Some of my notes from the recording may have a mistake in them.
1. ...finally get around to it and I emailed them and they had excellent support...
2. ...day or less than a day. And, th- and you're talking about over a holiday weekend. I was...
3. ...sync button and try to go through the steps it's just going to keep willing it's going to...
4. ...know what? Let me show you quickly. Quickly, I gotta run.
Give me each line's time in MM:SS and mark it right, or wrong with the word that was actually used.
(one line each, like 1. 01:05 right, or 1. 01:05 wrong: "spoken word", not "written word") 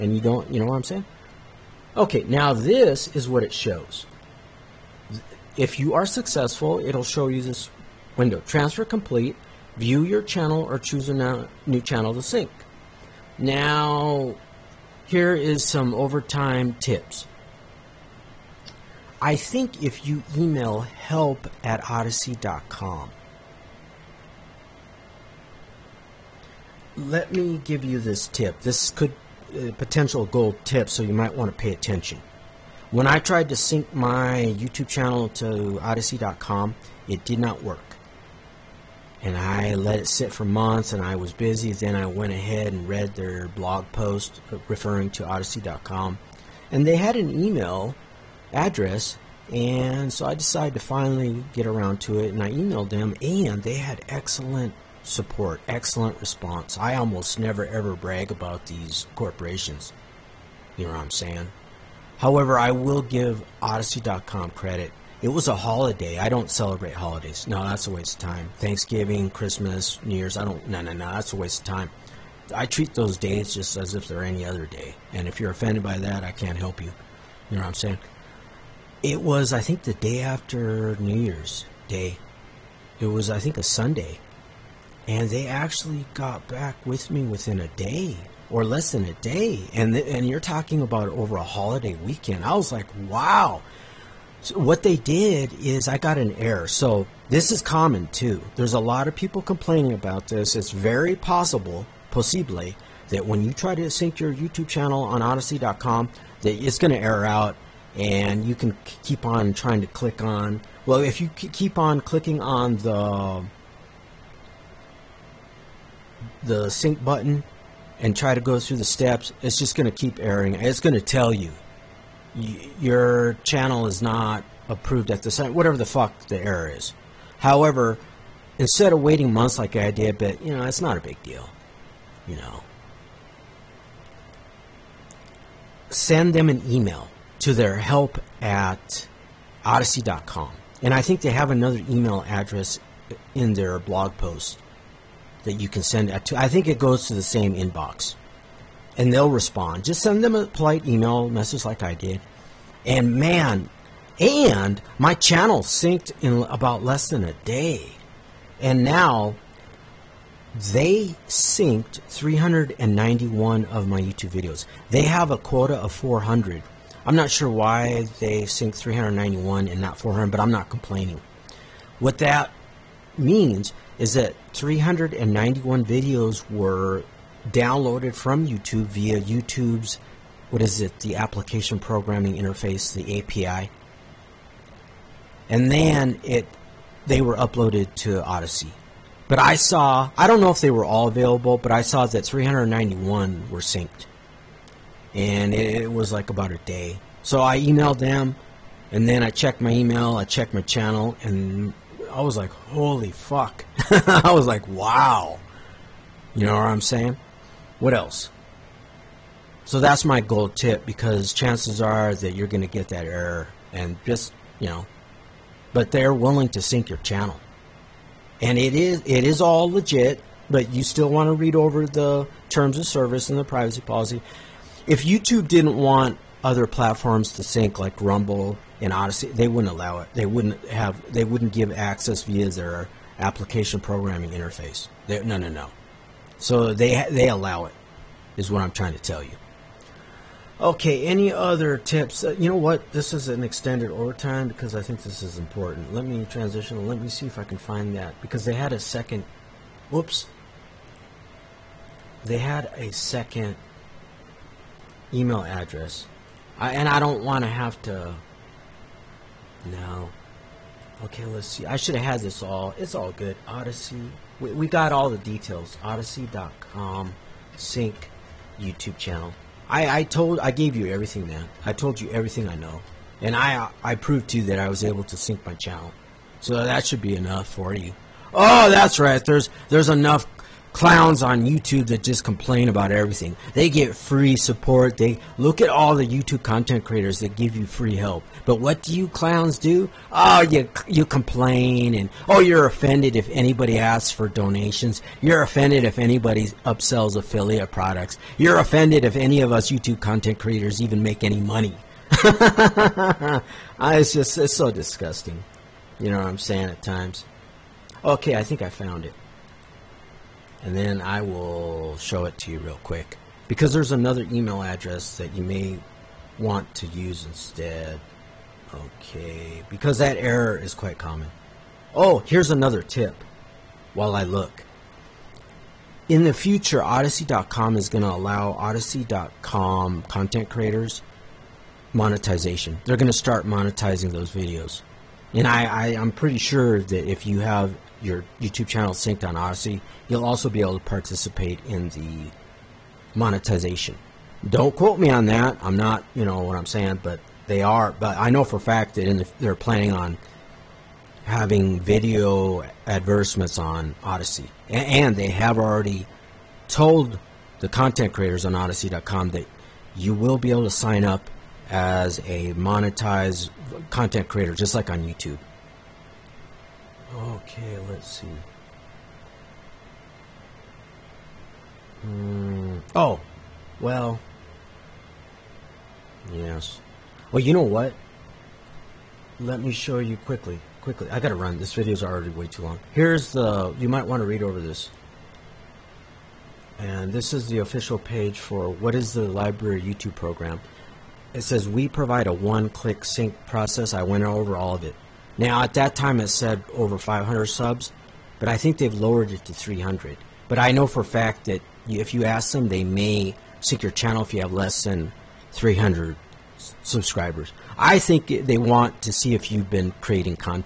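1. 00:50 right
2. 01:27 right
3. 01:56 wrong: "erroring", not "willing"
4. 06:17 right.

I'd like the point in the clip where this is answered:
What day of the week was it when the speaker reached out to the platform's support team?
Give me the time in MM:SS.
01:23.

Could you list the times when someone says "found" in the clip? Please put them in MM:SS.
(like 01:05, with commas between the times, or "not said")
05:08.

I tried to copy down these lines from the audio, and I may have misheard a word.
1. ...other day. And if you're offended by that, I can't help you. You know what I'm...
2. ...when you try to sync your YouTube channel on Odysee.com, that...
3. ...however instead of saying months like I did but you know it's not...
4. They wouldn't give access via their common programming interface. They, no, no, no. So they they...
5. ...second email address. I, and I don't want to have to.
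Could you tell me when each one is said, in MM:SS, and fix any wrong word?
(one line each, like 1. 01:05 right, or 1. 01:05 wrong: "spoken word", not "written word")
1. 01:14 right
2. 01:43 right
3. 02:07 wrong: "waiting", not "saying"
4. 03:51 wrong: "application", not "common"
5. 04:12 right.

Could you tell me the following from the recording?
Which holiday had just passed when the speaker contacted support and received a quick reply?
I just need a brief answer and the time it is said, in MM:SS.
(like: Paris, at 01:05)
New Year's Day, at 01:20.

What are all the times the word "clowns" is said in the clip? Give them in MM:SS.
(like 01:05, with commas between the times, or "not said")
04:40, 04:49.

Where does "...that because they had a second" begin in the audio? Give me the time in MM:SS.
04:07.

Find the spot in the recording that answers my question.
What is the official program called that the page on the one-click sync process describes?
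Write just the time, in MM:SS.
06:29.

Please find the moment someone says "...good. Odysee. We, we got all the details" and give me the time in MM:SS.
04:23.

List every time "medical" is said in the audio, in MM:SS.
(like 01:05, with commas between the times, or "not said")
not said.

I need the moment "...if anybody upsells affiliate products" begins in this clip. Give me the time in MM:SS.
04:55.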